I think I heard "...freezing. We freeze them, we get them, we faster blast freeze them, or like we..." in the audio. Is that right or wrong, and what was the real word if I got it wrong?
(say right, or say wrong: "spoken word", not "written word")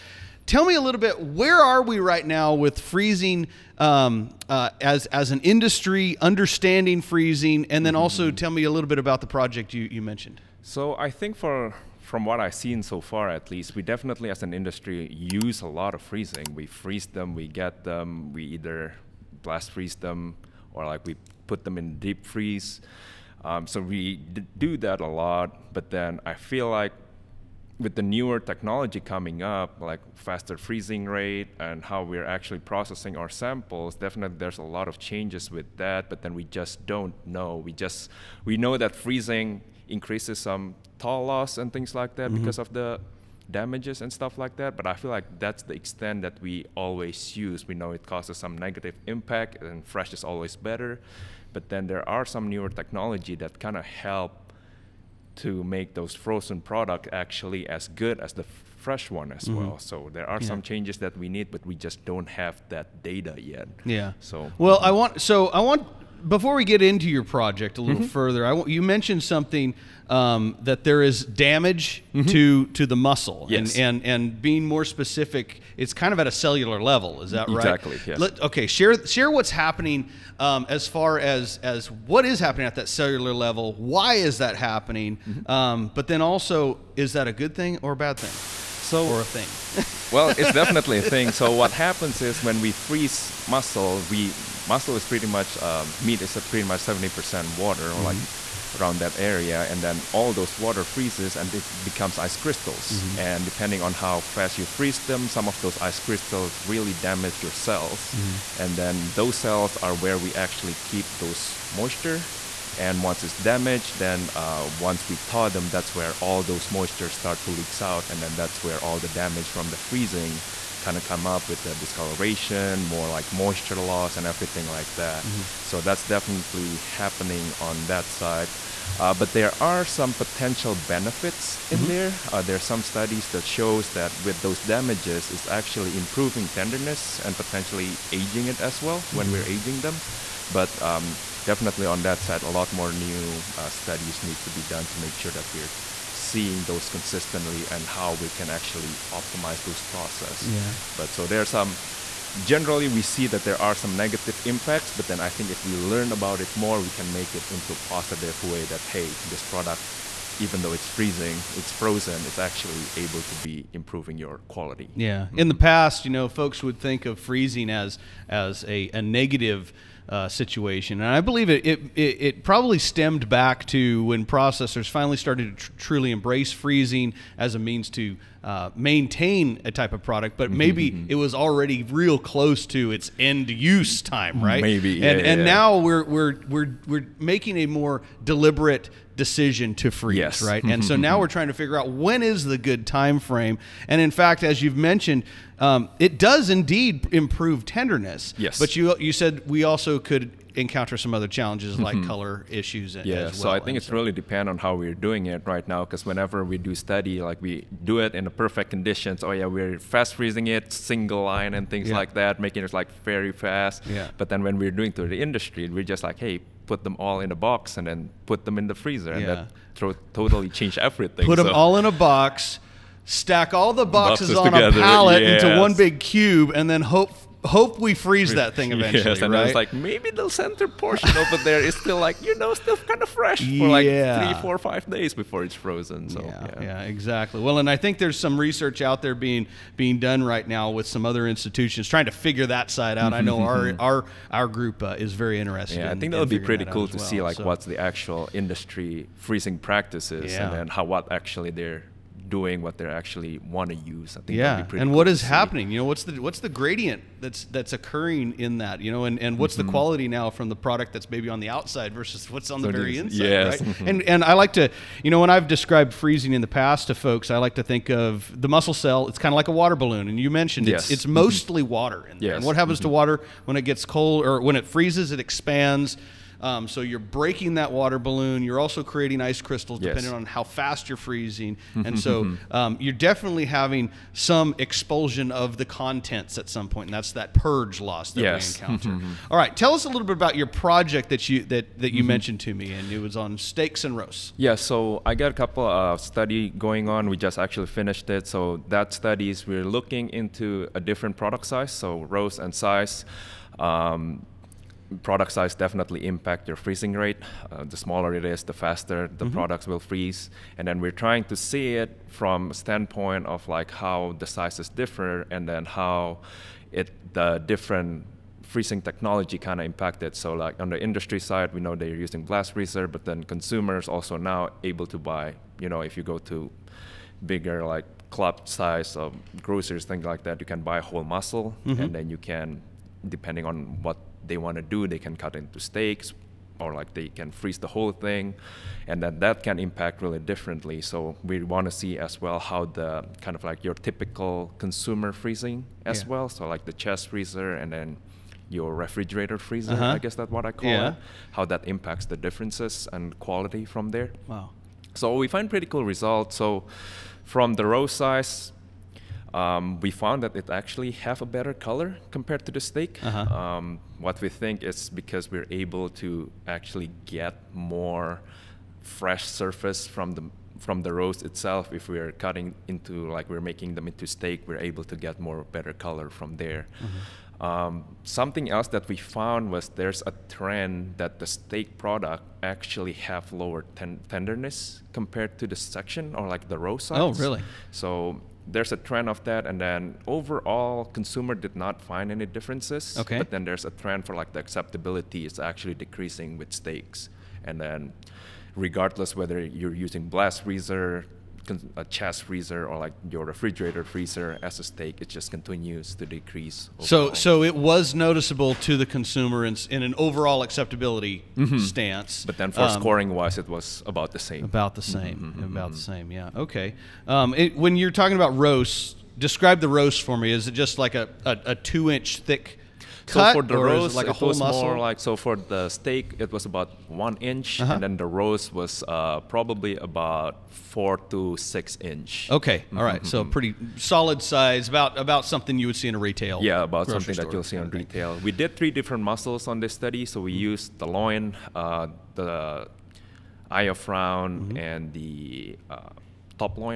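wrong: "either", not "faster".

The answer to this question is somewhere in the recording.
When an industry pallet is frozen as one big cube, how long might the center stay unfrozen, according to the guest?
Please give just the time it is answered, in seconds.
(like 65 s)
234 s.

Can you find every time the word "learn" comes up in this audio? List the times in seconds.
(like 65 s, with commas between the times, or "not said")
155 s.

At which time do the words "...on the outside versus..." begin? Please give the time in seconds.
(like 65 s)
261 s.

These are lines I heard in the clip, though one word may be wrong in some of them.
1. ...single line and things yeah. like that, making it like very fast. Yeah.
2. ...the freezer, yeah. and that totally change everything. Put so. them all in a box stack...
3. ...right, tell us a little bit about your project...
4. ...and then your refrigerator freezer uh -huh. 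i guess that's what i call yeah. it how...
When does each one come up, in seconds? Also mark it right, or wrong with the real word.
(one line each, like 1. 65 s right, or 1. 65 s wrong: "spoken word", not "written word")
1. 210 s right
2. 218 s right
3. 289 s right
4. 347 s right.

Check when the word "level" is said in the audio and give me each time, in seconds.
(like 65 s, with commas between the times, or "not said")
76 s, 83 s.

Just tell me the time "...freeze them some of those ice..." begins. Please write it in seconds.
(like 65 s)
104 s.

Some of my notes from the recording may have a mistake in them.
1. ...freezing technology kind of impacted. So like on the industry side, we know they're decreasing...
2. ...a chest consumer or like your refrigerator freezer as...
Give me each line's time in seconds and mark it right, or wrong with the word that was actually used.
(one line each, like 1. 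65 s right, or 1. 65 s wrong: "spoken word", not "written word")
1. 318 s wrong: "using", not "decreasing"
2. 401 s wrong: "freezer", not "consumer".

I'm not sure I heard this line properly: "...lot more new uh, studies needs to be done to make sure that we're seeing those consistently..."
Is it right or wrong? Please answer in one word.
right.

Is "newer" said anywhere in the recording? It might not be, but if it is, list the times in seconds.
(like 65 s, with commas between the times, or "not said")
28 s, 52 s.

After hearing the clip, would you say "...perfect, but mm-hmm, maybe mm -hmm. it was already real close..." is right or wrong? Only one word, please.
wrong.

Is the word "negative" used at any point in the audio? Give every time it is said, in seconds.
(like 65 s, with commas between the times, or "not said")
48 s, 153 s, 169 s.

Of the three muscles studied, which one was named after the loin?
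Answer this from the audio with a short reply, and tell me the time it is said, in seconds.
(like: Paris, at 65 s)
Eye of round, at 443 s.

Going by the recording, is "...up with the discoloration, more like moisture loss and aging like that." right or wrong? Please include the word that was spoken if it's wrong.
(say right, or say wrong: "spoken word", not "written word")
wrong: "everything", not "aging".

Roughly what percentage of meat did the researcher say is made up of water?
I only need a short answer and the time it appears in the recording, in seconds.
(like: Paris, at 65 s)
70%, at 96 s.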